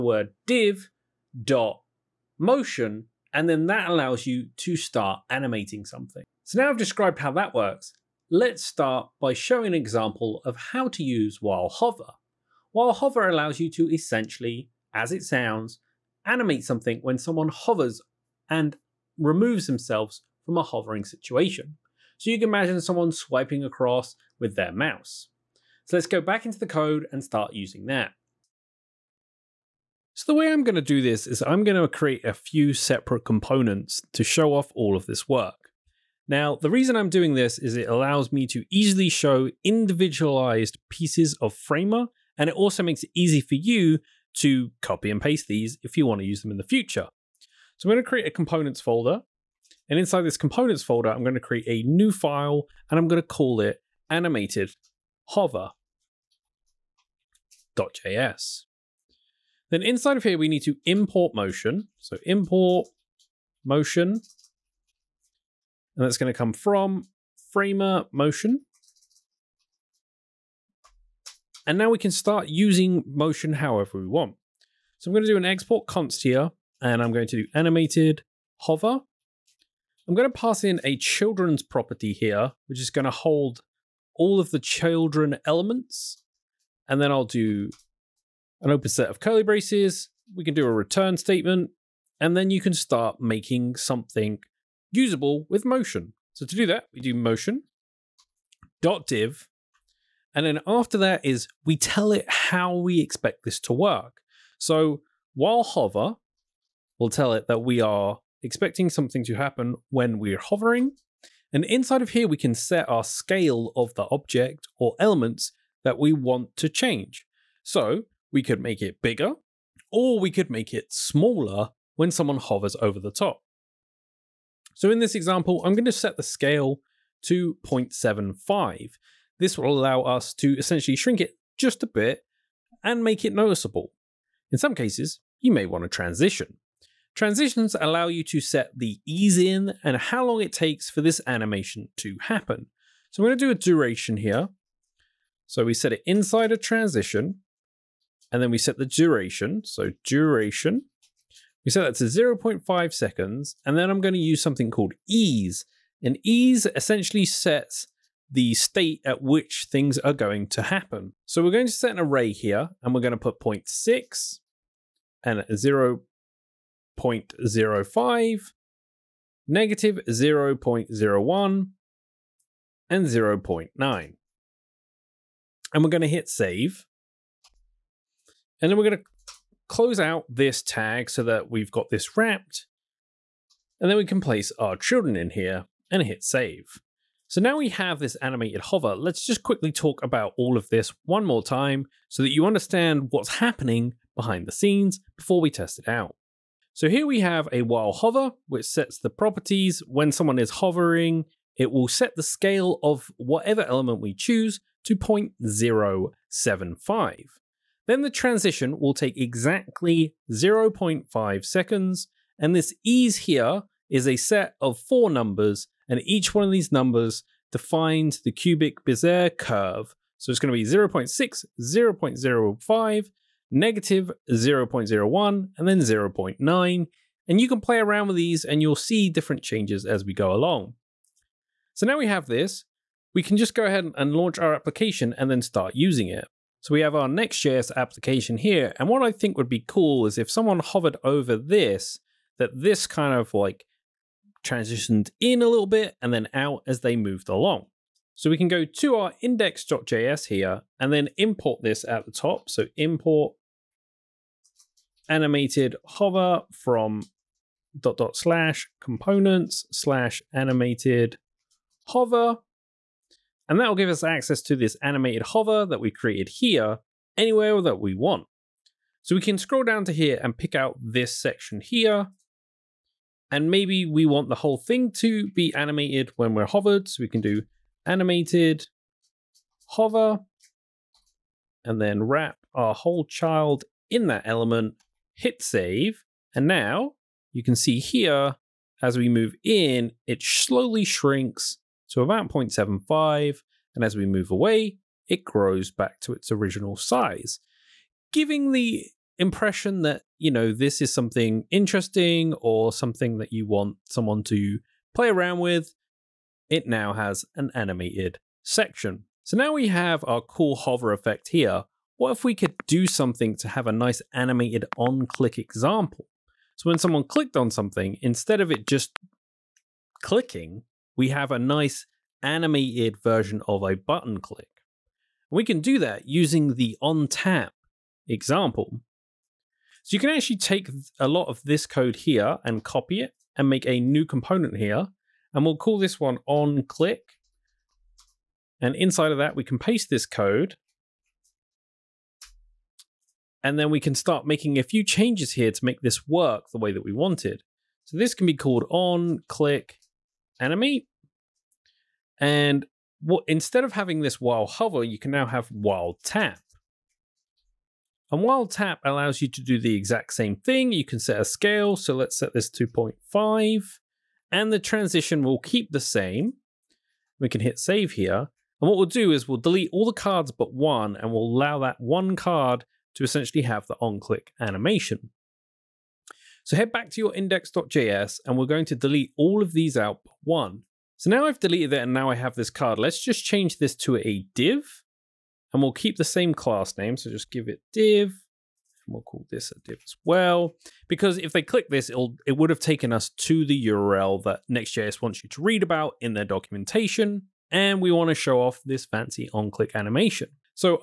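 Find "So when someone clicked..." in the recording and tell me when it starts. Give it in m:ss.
5:16.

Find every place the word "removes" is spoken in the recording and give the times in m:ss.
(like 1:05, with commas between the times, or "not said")
0:19.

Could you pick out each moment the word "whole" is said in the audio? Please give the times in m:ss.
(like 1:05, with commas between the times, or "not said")
4:34, 4:42.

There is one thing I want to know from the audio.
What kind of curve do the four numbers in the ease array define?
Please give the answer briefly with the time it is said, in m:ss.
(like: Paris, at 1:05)
cubic Bezier curve, at 3:38.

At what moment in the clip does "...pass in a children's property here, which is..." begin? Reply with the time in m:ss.
1:20.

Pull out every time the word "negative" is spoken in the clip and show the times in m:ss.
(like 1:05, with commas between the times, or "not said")
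2:49, 3:43.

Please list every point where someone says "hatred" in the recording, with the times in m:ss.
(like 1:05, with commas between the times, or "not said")
not said.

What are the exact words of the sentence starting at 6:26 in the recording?
So just give it div and we'll call this a div as well.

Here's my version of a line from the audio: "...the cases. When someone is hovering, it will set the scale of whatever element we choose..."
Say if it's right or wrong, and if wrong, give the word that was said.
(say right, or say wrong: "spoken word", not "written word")
wrong: "properties", not "cases".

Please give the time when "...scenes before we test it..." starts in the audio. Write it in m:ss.
3:14.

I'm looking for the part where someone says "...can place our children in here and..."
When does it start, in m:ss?
3:04.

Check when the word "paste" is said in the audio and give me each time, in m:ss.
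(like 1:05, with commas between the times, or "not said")
0:45, 5:39.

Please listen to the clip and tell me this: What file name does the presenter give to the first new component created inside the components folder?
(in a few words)
animated hover.js.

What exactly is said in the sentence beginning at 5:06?
It now has an animated section.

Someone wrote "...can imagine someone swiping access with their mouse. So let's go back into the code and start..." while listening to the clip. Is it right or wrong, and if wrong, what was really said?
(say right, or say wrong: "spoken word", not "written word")
wrong: "across", not "access".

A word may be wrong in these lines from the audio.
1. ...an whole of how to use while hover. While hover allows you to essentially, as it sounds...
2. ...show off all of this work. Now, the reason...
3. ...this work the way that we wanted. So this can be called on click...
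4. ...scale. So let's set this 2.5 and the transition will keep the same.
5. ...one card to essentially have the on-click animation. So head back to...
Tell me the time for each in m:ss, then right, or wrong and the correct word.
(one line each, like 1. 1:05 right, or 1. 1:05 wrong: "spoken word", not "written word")
1. 0:09 wrong: "example", not "whole"
2. 0:34 right
3. 5:45 right
4. 6:01 right
5. 6:11 right.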